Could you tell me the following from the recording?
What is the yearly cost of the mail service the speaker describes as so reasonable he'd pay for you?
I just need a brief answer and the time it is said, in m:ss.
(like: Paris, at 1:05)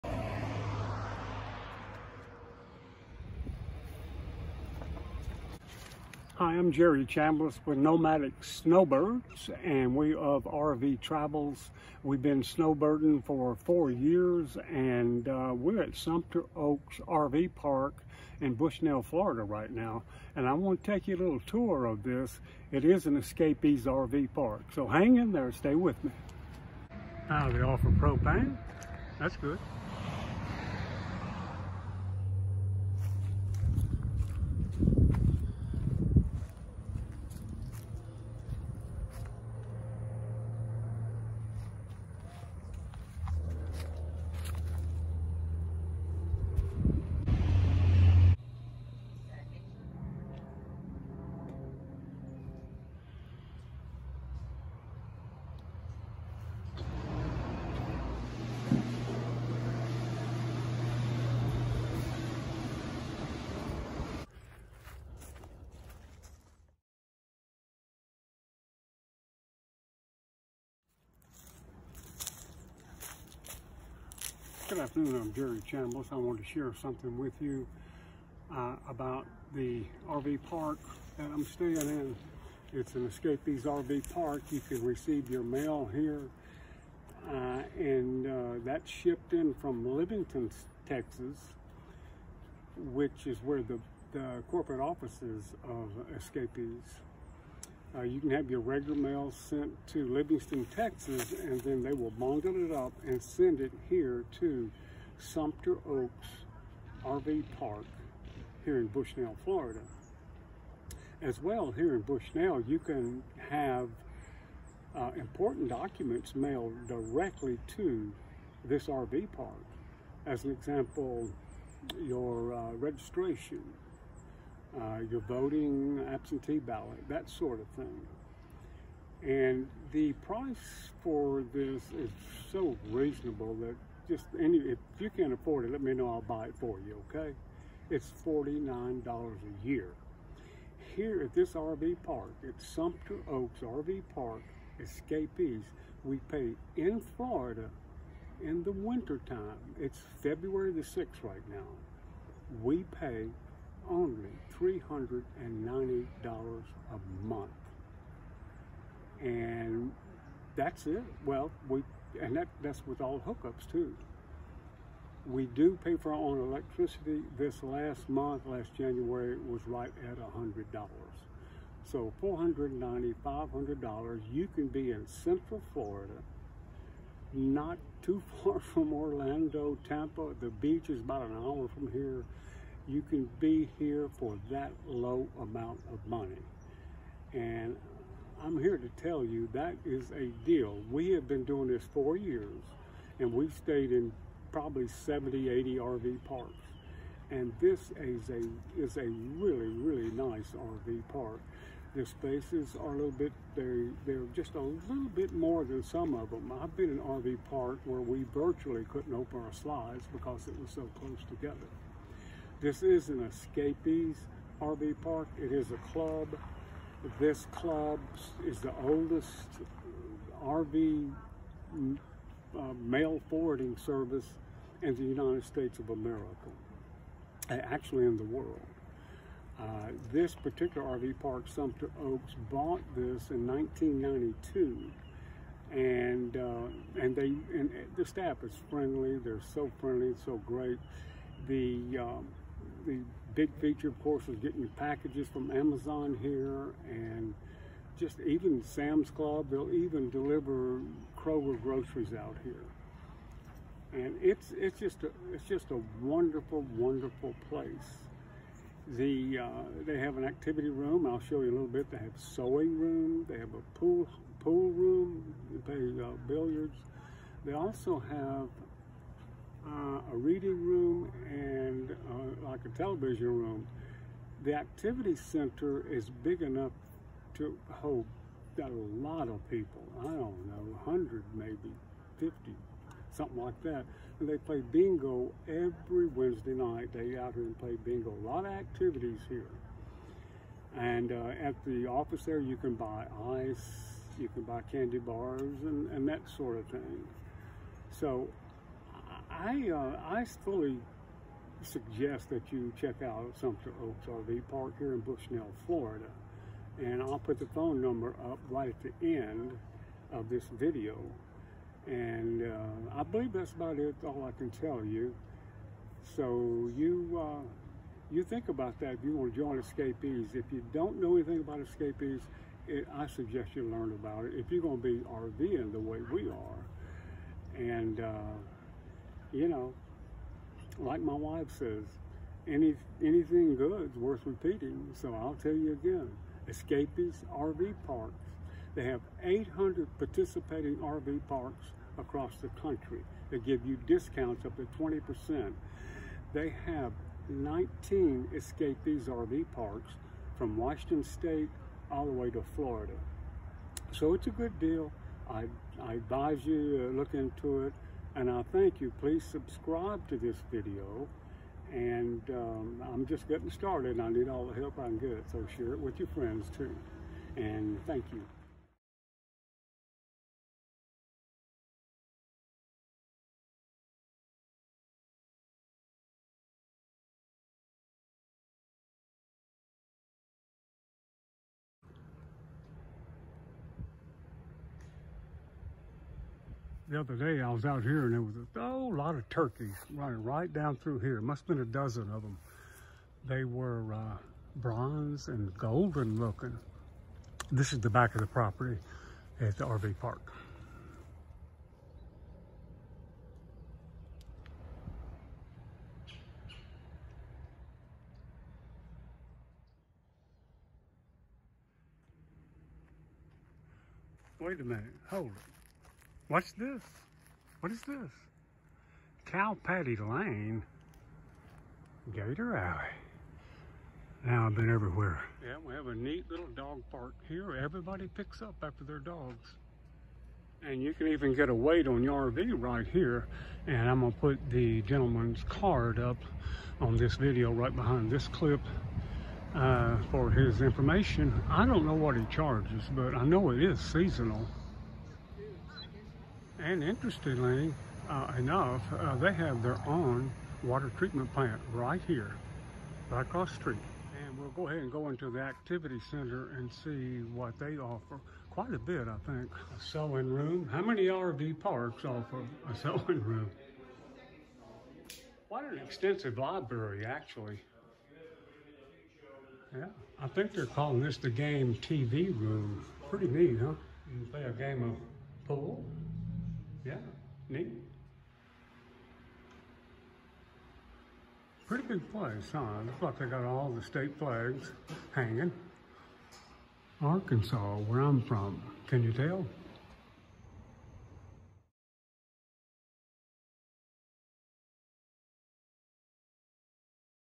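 $49, at 2:18.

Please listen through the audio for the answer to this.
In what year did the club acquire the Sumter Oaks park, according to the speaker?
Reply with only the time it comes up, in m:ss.
3:53.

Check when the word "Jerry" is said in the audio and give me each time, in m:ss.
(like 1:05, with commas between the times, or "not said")
0:06, 1:15.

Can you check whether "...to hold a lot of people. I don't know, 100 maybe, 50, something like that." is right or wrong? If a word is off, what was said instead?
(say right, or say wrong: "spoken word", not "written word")
right.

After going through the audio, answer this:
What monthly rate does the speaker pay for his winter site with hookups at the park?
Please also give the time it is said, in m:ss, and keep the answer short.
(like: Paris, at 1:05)
$390, at 2:34.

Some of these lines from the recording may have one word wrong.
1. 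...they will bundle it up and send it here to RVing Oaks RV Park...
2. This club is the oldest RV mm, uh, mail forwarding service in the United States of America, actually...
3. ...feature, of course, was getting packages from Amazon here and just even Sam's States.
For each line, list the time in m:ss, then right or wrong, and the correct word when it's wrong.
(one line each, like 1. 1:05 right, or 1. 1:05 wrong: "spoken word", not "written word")
1. 1:41 wrong: "Sumter", not "RVing"
2. 3:37 right
3. 4:03 wrong: "Club", not "States".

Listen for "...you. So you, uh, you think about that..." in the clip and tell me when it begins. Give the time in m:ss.
5:14.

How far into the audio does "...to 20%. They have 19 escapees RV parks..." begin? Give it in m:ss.
5:44.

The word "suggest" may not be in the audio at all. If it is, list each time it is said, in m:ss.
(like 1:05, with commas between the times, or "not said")
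5:01, 5:23.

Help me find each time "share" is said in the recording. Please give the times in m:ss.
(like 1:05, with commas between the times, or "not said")
1:16, 6:05.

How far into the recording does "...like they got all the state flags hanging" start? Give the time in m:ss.
8:03.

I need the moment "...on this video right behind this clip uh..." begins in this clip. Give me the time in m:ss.
7:16.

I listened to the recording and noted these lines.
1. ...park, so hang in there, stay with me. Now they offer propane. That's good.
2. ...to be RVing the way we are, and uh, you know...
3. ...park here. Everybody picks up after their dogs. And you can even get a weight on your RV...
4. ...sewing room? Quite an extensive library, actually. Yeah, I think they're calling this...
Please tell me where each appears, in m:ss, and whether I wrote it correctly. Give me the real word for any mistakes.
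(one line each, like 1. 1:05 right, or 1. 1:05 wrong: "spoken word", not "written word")
1. 0:24 right
2. 5:24 right
3. 7:06 right
4. 7:42 right.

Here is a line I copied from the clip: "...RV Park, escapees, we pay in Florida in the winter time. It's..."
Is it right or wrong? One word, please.
right.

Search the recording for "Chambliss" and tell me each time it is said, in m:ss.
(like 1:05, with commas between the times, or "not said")
0:07, 1:15.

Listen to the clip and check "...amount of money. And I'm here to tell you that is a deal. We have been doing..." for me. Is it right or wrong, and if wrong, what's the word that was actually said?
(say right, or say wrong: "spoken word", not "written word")
right.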